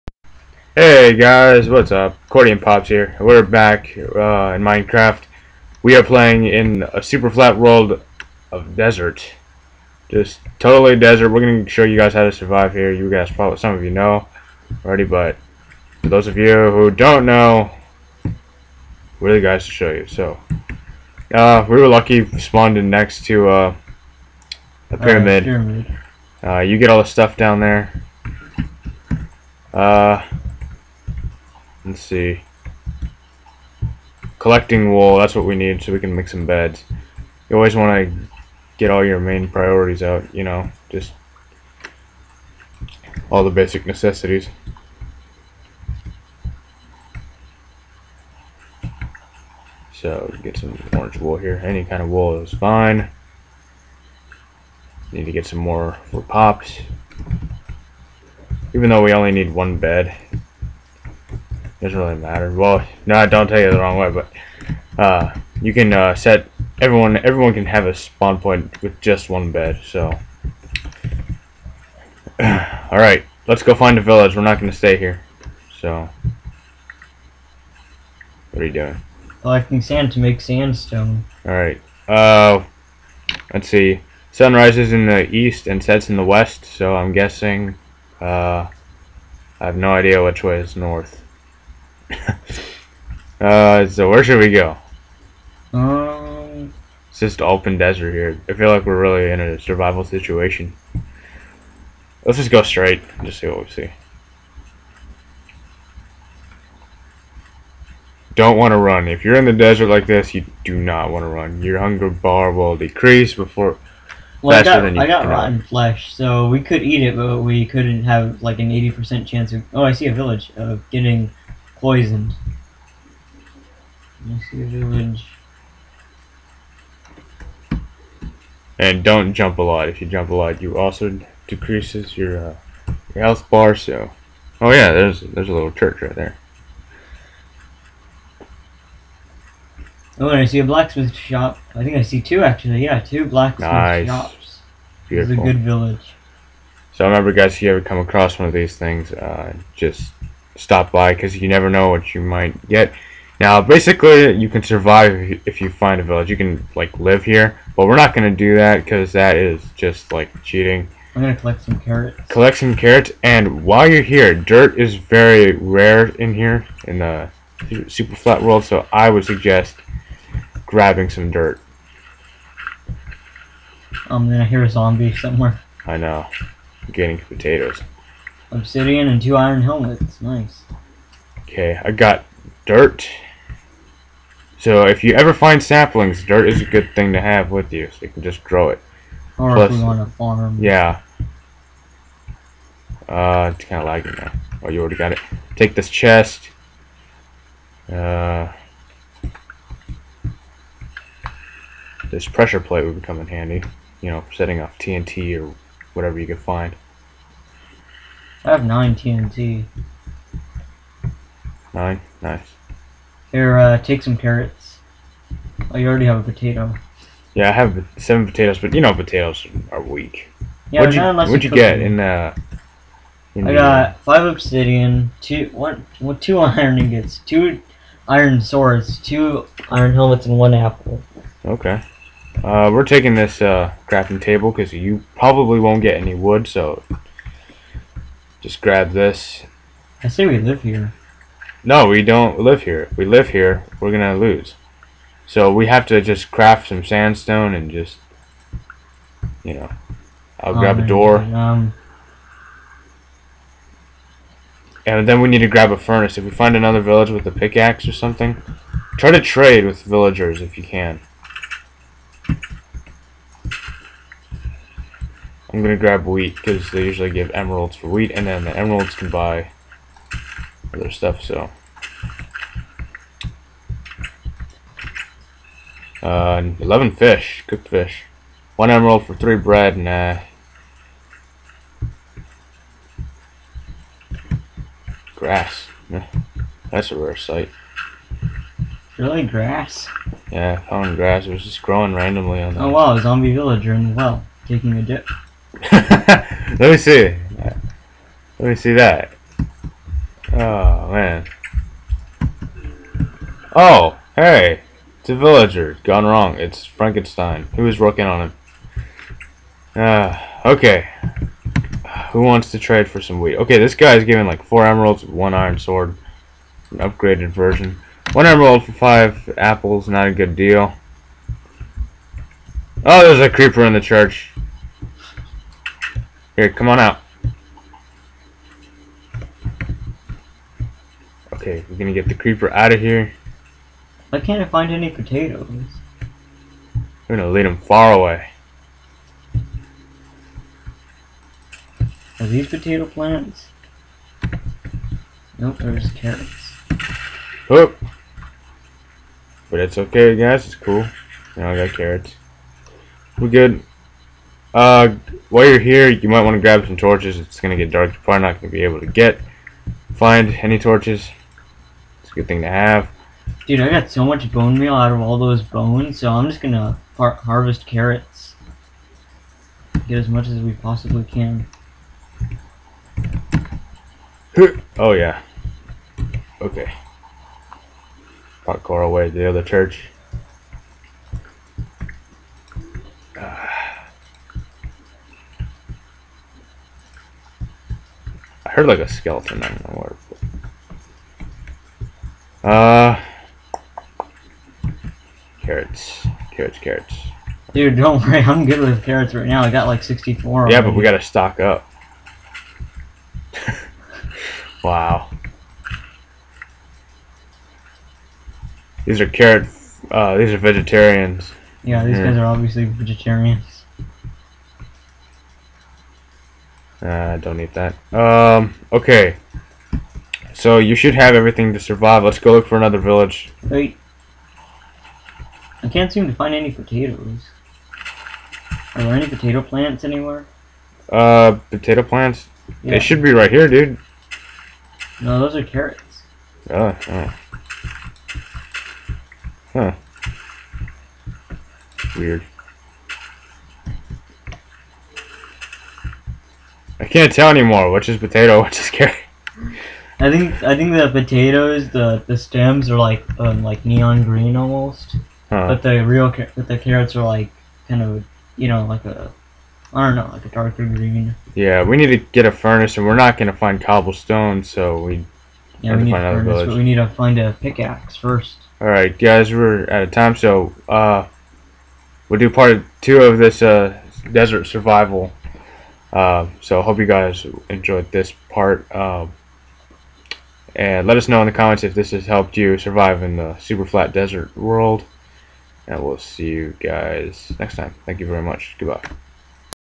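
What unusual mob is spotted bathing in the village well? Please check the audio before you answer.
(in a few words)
zombie villager.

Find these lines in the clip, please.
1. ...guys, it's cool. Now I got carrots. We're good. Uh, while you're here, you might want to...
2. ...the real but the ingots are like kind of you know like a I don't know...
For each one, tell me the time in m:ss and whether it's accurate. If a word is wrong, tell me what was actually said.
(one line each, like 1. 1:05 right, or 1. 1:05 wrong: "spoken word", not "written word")
1. 5:50 right
2. 7:35 wrong: "carrots", not "ingots".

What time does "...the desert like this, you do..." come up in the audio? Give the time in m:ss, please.
1:49.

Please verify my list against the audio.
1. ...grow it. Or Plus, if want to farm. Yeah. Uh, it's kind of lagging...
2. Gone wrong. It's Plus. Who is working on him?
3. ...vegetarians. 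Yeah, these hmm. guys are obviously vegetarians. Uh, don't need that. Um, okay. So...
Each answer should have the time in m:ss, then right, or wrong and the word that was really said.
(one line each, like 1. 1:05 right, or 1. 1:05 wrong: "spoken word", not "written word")
1. 3:08 right
2. 5:05 wrong: "Frankenstein", not "Plus"
3. 6:50 right.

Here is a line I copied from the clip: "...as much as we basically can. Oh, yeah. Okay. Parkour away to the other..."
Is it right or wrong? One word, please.
wrong.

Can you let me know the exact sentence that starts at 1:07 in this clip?
Everyone can have a spawn point with just one bed.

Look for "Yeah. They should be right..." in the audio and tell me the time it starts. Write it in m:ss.
7:12.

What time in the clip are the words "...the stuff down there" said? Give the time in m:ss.
0:26.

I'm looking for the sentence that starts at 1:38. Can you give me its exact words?
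I feel like we're really in a survival situation.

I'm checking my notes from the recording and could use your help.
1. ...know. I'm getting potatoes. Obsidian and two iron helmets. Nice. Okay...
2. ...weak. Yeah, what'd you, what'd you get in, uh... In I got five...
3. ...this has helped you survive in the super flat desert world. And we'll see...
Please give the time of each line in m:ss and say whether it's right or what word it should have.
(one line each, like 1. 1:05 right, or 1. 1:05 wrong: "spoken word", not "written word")
1. 2:55 right
2. 3:39 right
3. 8:01 right.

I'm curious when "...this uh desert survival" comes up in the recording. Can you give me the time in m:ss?
7:53.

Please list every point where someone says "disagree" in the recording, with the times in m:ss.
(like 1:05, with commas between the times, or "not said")
not said.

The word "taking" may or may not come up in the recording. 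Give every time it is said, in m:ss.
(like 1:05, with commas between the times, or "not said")
3:52, 4:54.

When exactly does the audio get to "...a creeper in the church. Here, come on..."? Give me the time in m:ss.
5:23.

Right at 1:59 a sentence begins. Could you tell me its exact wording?
Oh, I see a village of getting poisoned.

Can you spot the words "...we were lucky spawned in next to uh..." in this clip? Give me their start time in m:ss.
0:21.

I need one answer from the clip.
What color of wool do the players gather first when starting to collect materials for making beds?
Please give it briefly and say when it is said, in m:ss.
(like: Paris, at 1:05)
orange, at 0:50.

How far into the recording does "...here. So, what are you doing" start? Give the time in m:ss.
1:14.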